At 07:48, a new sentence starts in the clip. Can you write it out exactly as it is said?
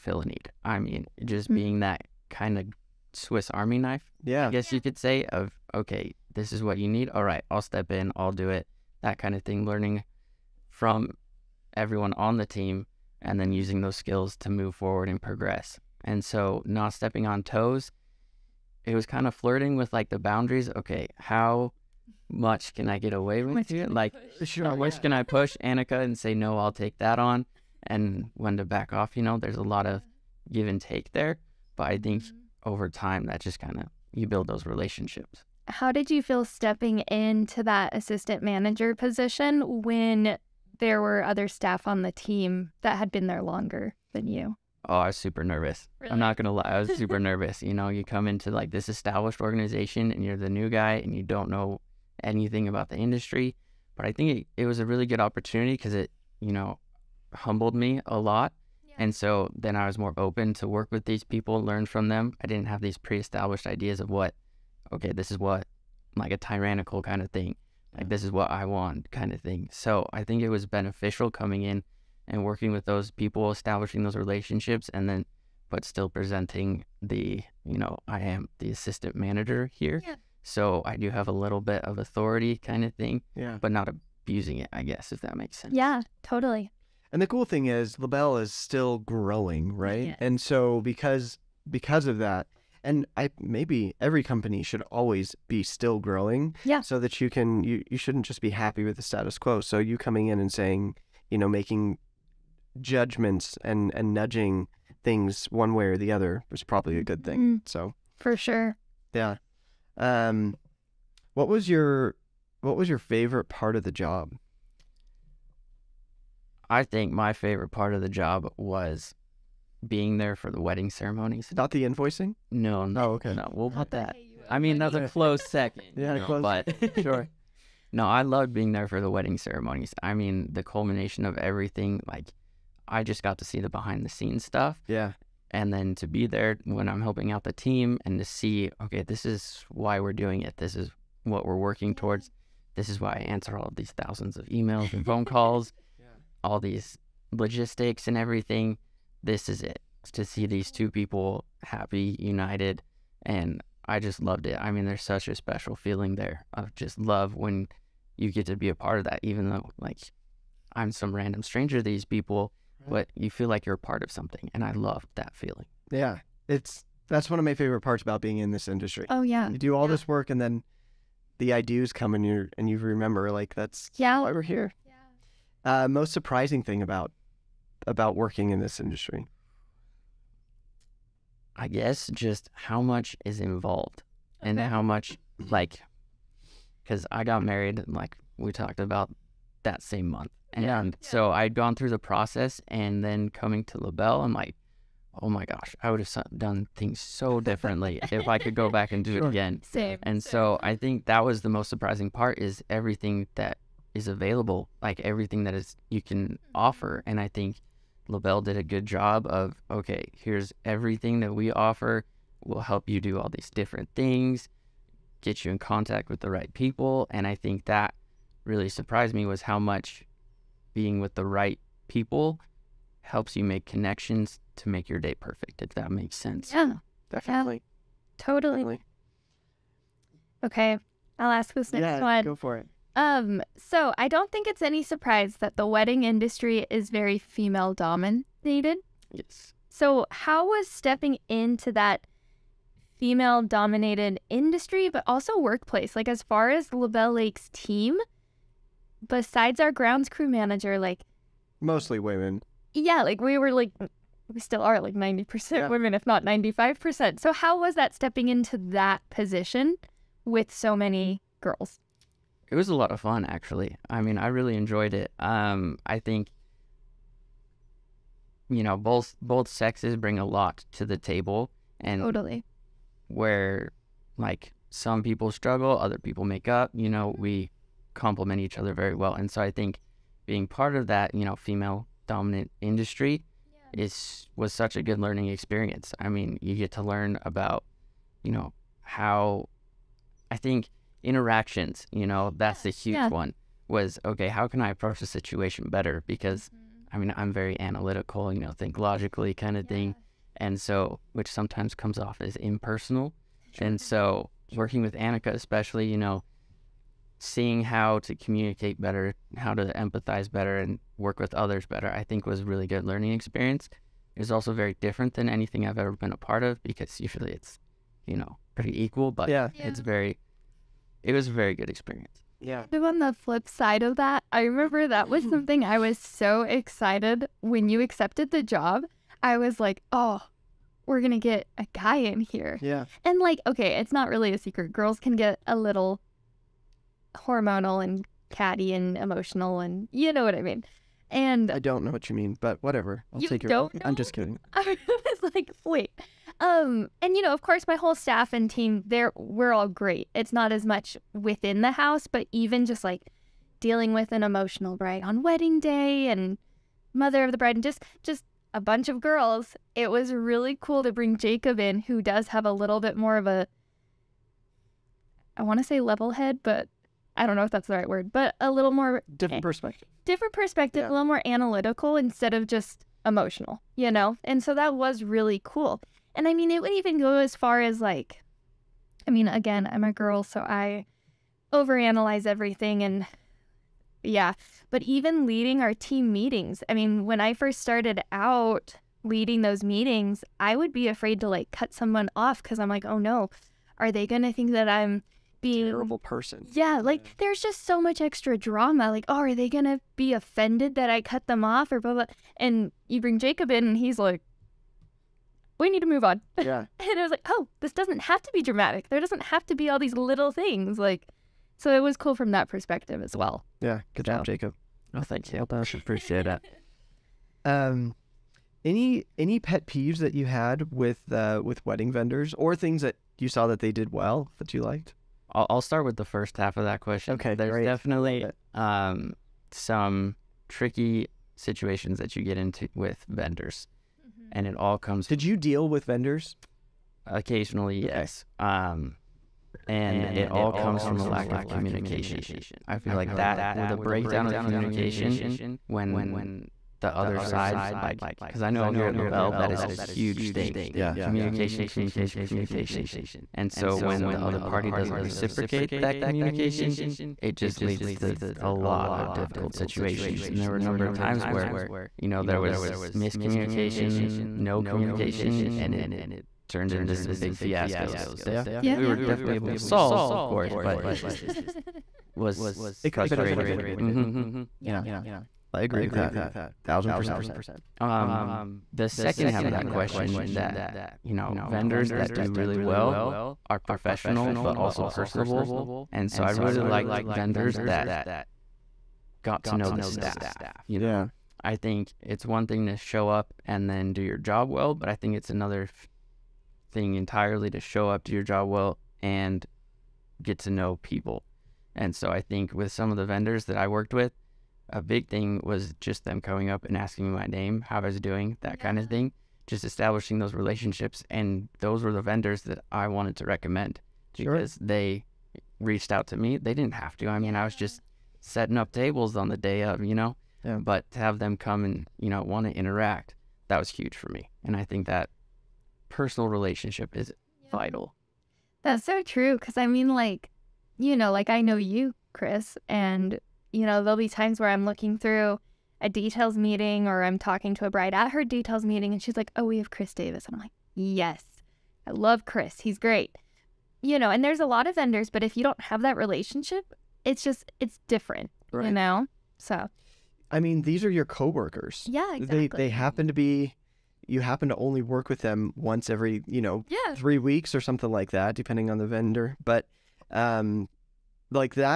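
we were definitely able to solve, of course, yes.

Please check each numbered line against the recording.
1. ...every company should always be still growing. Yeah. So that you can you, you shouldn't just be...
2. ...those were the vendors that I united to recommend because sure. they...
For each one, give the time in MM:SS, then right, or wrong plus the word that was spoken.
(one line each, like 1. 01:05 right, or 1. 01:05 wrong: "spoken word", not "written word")
1. 01:34 right
2. 08:31 wrong: "wanted", not "united".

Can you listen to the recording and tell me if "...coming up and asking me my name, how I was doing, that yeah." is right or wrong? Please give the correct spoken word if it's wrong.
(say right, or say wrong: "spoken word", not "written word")
right.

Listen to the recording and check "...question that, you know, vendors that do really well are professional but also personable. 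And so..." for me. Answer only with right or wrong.
right.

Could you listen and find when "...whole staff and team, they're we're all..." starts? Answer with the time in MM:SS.
05:47.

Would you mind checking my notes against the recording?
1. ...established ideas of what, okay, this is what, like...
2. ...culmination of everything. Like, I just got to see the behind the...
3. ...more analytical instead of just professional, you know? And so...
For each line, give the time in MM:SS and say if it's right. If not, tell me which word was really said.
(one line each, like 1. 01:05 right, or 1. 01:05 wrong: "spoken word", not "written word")
1. 01:03 right
2. 02:10 right
3. 06:11 wrong: "emotional", not "professional".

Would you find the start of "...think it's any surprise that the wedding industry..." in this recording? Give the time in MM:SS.
03:54.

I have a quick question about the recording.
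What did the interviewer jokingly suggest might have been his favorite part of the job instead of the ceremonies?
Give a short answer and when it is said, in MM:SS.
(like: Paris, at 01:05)
Invoicing, at 02:01.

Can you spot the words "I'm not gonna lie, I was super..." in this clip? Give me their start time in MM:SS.
00:46.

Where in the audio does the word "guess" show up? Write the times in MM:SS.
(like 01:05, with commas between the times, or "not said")
00:04, 01:24, 03:01.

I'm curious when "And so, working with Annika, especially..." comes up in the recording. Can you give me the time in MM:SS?
05:03.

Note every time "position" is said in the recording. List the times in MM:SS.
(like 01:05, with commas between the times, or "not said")
00:38, 04:19.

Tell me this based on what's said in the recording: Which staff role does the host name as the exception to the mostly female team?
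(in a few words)
Grounds crew manager.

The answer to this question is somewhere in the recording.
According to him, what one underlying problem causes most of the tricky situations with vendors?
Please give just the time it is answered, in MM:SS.
07:21.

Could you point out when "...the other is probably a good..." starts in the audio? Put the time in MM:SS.
01:45.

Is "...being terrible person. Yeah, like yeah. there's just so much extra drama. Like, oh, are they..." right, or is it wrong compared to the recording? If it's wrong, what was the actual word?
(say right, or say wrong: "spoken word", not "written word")
right.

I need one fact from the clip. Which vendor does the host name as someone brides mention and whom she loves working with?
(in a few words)
Chris Davis.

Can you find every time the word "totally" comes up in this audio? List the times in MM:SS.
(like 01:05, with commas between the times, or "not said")
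01:26, 03:48, 04:32.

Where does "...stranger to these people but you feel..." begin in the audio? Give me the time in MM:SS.
02:41.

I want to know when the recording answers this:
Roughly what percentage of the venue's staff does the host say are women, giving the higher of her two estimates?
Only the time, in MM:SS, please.
04:16.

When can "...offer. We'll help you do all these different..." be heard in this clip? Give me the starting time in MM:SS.
03:31.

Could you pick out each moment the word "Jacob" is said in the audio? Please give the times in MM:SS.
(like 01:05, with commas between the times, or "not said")
06:01, 06:43, 06:54.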